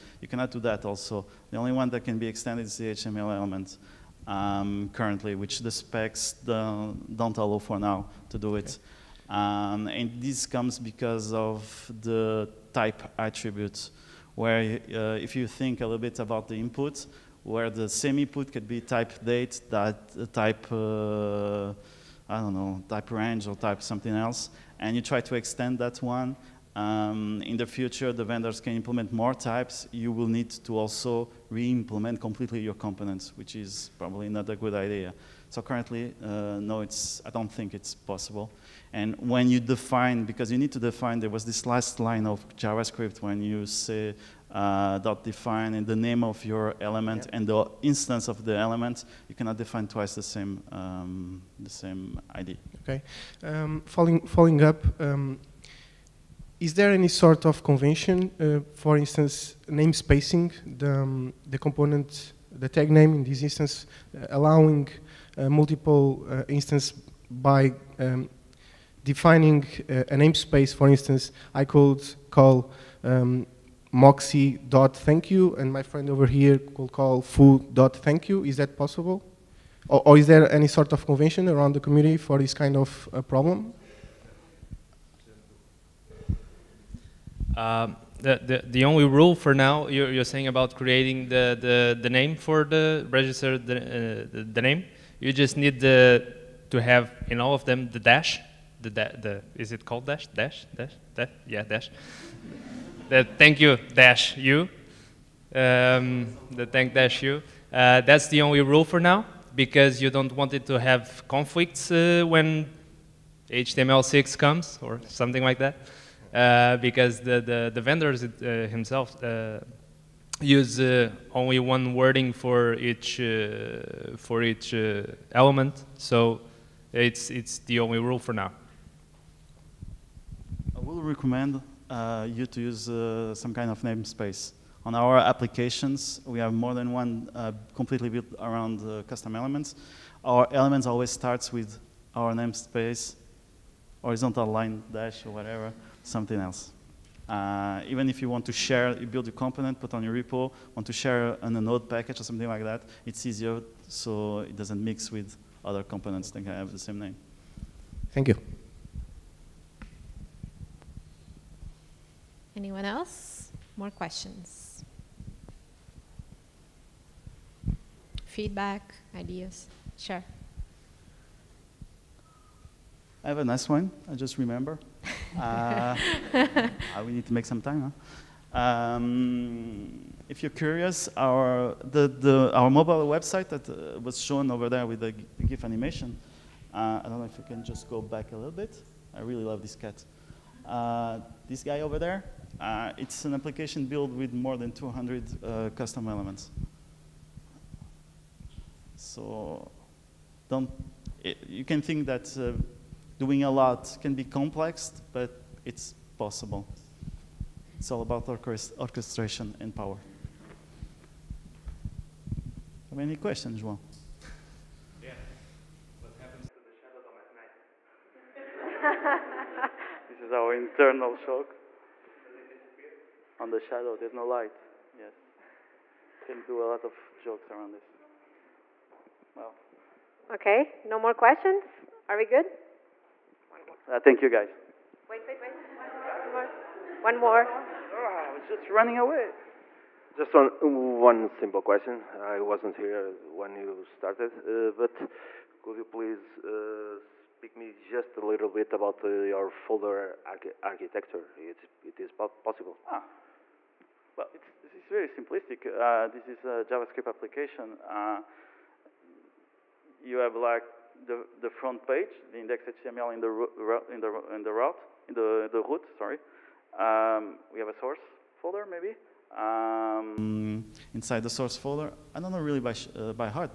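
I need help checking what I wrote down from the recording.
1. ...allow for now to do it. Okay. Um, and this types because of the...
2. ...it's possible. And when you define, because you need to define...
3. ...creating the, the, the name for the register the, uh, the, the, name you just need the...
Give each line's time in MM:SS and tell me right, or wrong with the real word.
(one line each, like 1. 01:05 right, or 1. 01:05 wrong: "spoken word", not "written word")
1. 00:07 wrong: "comes", not "types"
2. 00:37 right
3. 01:30 right.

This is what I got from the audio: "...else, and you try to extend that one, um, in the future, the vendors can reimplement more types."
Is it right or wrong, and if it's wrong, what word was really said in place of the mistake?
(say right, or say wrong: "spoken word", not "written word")
wrong: "implement", not "reimplement".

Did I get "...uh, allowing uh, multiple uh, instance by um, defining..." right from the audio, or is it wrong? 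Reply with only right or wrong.
right.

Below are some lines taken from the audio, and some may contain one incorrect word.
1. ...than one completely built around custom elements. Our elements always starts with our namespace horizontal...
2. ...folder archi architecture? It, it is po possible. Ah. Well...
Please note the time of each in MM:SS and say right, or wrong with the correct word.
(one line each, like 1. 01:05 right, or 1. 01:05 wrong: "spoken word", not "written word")
1. 02:16 right
2. 04:09 right.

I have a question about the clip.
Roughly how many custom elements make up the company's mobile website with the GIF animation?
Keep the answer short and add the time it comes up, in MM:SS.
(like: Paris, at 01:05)
more than 200, at 03:14.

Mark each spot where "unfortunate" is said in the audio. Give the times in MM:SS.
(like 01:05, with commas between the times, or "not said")
not said.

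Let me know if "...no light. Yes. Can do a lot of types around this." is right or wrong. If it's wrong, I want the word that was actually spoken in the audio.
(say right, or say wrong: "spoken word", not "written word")
wrong: "jokes", not "types".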